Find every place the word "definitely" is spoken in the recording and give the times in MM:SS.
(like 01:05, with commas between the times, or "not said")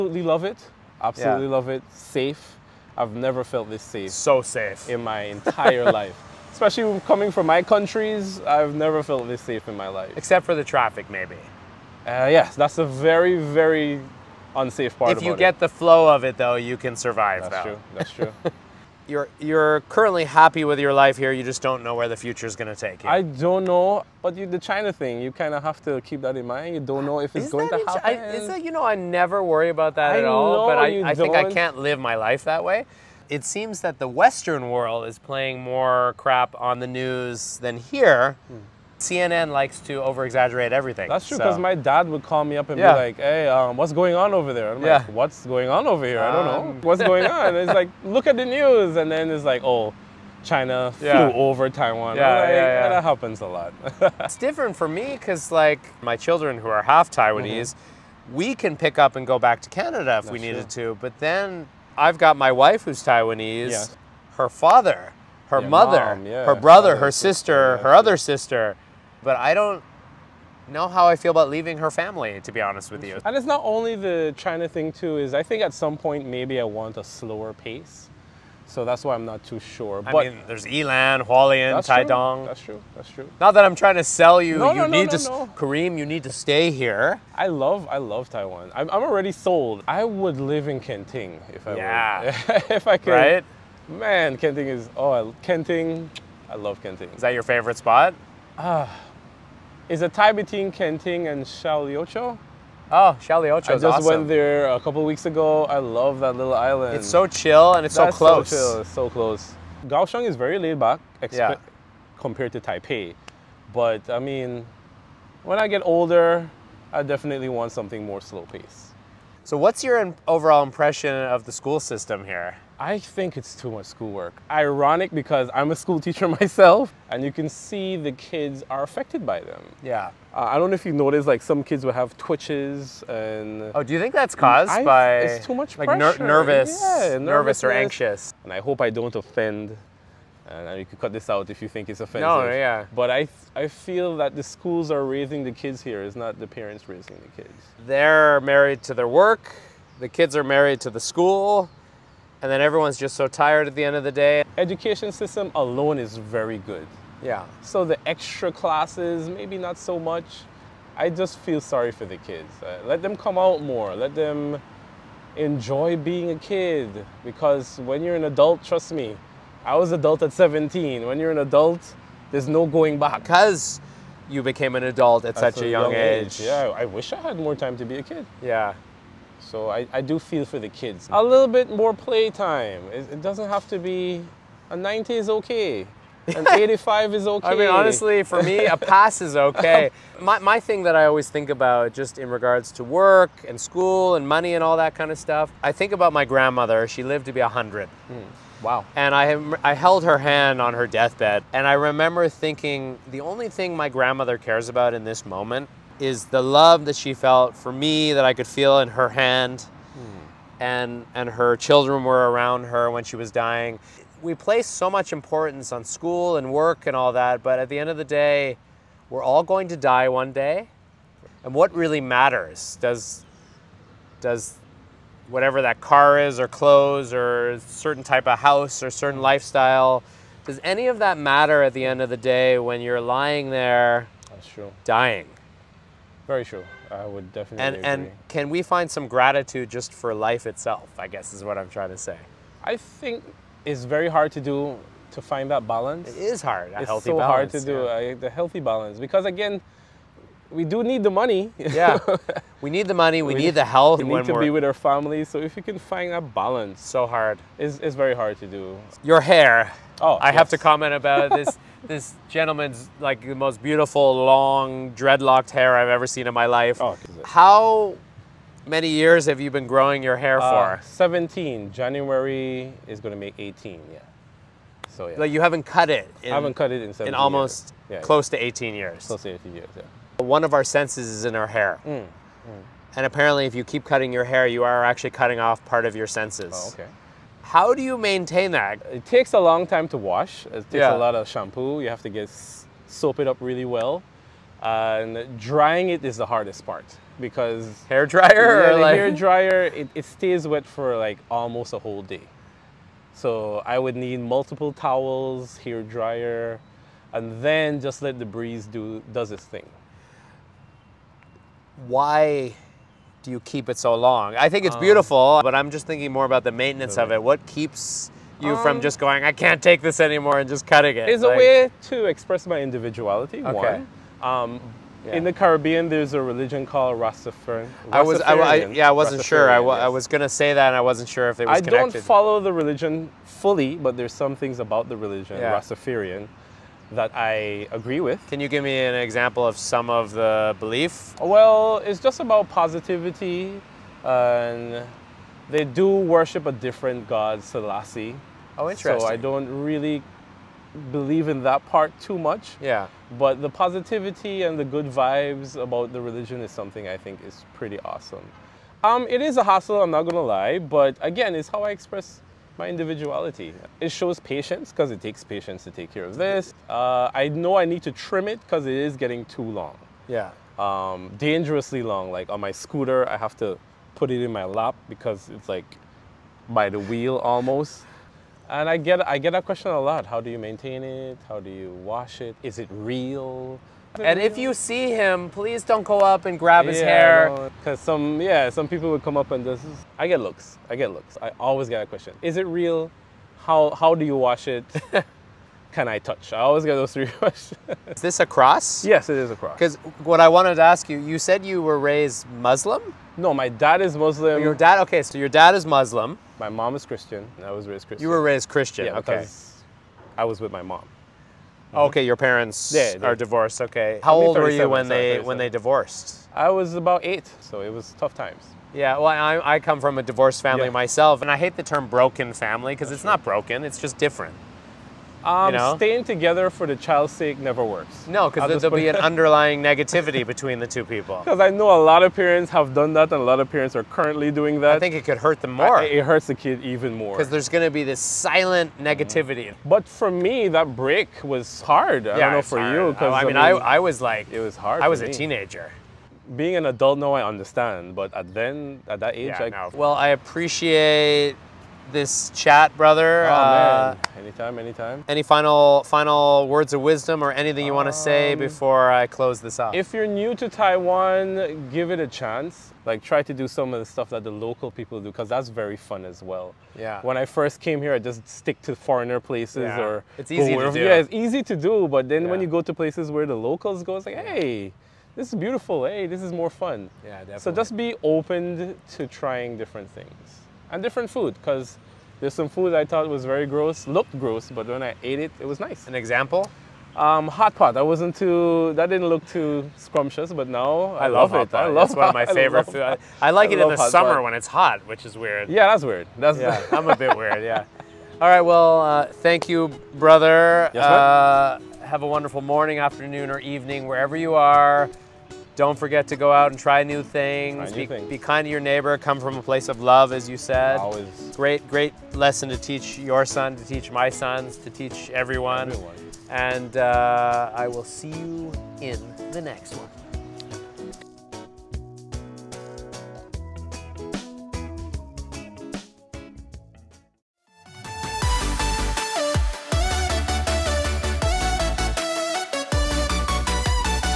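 01:57, 03:57, 07:57.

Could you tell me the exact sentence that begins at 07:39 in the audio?
If you're new to Taiwan, give it a chance.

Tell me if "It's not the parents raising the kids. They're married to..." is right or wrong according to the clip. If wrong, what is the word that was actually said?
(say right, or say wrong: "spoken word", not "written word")
right.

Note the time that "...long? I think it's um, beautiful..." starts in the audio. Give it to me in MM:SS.
05:13.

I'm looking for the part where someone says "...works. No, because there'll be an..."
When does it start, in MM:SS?
07:07.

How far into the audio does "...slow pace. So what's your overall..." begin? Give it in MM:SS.
01:58.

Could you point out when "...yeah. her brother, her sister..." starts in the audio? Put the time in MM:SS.
01:06.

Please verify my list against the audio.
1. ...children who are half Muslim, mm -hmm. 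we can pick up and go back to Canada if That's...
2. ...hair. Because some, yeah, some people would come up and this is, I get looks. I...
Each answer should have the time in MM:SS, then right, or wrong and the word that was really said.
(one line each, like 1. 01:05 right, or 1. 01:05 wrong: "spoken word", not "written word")
1. 00:56 wrong: "Taiwanese", not "Muslim"
2. 06:27 right.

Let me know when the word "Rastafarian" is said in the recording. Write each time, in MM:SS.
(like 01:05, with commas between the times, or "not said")
05:26, 05:35.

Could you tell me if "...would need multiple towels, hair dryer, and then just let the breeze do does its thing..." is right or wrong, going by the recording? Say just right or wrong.
right.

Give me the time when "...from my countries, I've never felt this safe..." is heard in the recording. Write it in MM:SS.
00:07.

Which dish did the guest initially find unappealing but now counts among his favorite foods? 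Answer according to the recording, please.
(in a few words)
Hot pot.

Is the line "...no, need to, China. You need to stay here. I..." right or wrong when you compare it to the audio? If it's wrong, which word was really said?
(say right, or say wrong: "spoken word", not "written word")
wrong: "Kareem", not "China".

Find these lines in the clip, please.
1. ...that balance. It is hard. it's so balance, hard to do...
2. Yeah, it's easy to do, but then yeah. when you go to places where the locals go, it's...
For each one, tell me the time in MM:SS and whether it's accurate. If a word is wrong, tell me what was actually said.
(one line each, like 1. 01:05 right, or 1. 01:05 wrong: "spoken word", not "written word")
1. 04:05 right
2. 07:50 right.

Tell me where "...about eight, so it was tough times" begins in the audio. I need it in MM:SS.
06:56.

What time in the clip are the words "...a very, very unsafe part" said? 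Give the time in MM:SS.
00:12.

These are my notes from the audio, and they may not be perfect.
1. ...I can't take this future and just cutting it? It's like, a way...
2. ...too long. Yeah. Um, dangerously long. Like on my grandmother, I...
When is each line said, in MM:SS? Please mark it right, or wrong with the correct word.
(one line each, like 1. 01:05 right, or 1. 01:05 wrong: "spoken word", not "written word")
1. 05:19 wrong: "anymore", not "future"
2. 06:09 wrong: "scooter", not "grandmother".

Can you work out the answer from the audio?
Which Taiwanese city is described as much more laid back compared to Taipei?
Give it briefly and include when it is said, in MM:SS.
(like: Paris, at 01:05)
Kaohsiung, at 01:49.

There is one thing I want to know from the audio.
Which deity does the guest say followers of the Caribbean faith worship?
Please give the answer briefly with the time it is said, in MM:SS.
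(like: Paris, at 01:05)
Selassie, at 05:47.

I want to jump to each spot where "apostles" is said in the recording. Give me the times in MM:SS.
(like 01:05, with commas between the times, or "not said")
not said.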